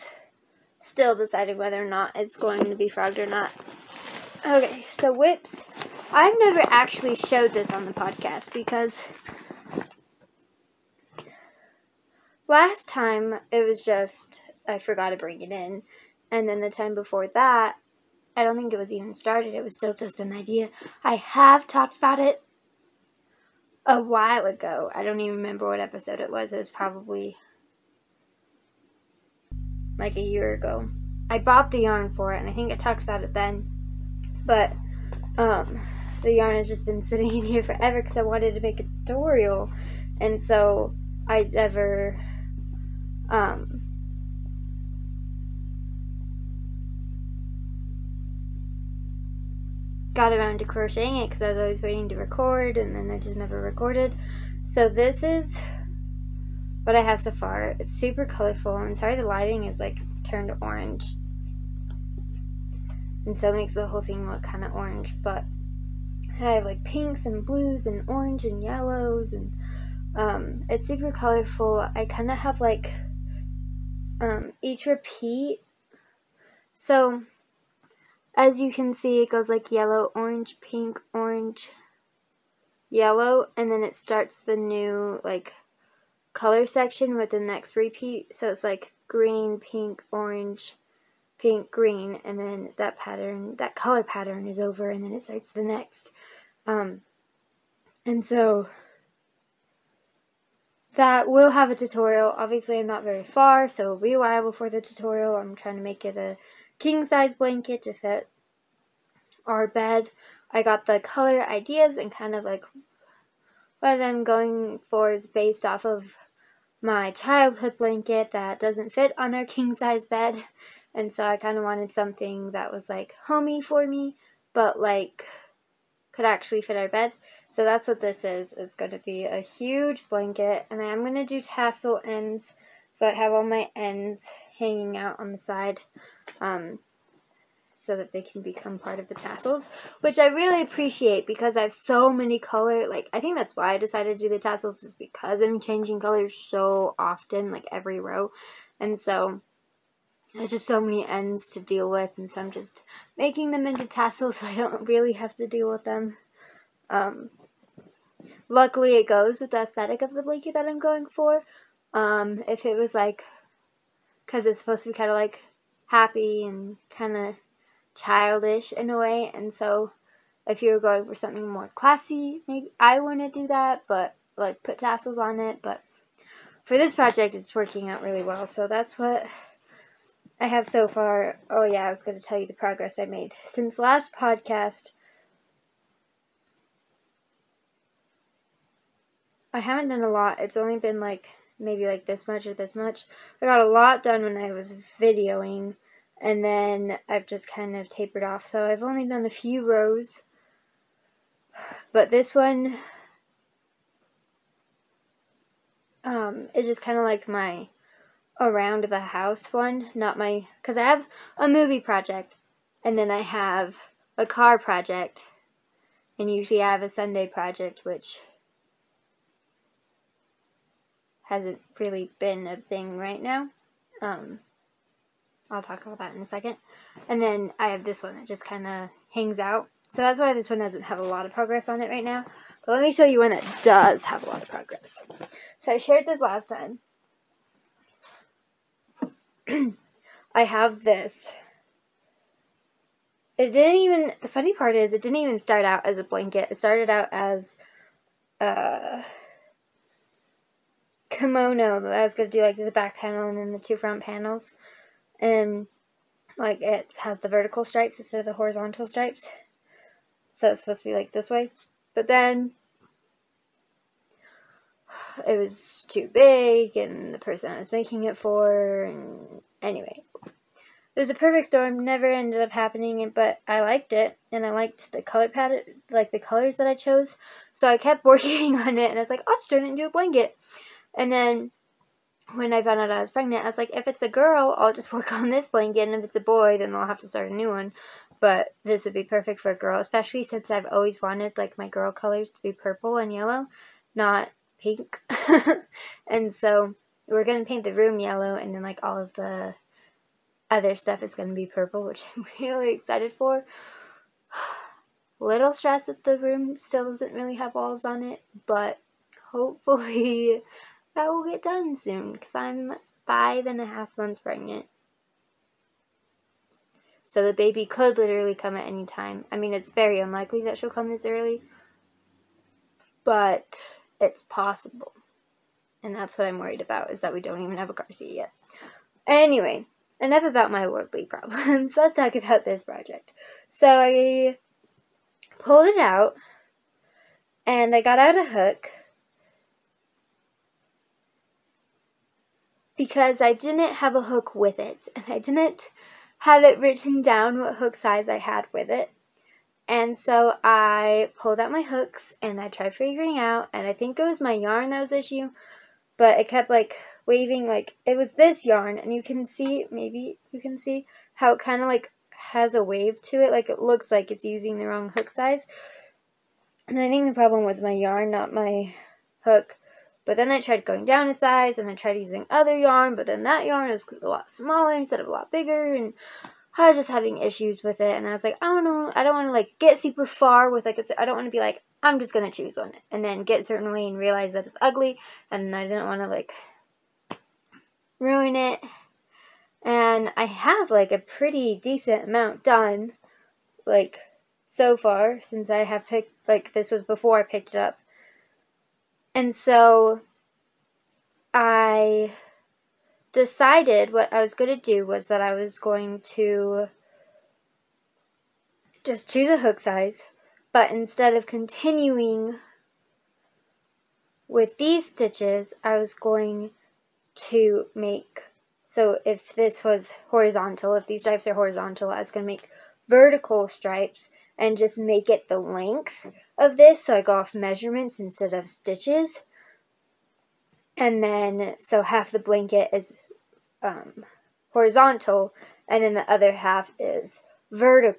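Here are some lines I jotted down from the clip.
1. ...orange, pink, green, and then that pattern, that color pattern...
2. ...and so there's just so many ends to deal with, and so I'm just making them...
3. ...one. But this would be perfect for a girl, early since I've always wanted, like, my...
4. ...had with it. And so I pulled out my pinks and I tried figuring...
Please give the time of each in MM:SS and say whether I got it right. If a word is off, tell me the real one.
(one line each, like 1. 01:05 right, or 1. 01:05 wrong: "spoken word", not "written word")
1. 01:30 right
2. 02:28 right
3. 04:47 wrong: "especially", not "early"
4. 05:48 wrong: "hooks", not "pinks".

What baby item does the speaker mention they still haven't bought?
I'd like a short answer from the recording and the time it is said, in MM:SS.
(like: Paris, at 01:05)
car seat, at 05:27.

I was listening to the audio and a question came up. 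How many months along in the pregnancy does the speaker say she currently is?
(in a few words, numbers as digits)
5 and a half.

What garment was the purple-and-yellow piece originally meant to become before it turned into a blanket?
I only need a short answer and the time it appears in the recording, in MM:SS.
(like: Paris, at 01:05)
kimono, at 04:11.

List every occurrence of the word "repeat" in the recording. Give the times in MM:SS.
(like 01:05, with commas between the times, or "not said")
01:14, 01:27.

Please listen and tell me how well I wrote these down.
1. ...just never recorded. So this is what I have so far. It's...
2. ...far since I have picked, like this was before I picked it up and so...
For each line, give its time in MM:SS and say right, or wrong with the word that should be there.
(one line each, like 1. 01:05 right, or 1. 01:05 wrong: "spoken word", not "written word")
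1. 00:53 right
2. 06:34 right.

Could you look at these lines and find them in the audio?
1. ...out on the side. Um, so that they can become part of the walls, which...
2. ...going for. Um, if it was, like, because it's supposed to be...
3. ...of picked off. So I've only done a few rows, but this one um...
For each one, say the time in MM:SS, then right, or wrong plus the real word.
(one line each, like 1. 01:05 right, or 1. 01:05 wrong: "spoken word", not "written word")
1. 02:14 wrong: "tassels", not "walls"
2. 02:40 right
3. 03:17 wrong: "tapered", not "picked".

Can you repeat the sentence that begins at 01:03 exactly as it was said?
And so it makes the whole thing look kind of orange.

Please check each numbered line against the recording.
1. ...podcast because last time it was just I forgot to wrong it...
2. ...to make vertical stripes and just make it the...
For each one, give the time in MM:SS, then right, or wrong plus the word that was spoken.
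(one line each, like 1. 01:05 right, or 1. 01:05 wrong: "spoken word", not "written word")
1. 00:07 wrong: "bring", not "wrong"
2. 07:02 right.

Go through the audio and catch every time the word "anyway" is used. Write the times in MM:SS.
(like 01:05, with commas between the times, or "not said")
04:29, 05:29.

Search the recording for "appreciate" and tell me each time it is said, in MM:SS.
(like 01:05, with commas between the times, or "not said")
02:20.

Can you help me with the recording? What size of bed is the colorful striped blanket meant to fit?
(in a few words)
king-size.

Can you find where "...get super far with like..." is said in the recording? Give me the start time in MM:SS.
06:19.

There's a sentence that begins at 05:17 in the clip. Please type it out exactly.
So the baby could literally come at any time.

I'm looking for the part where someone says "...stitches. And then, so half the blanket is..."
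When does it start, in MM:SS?
07:08.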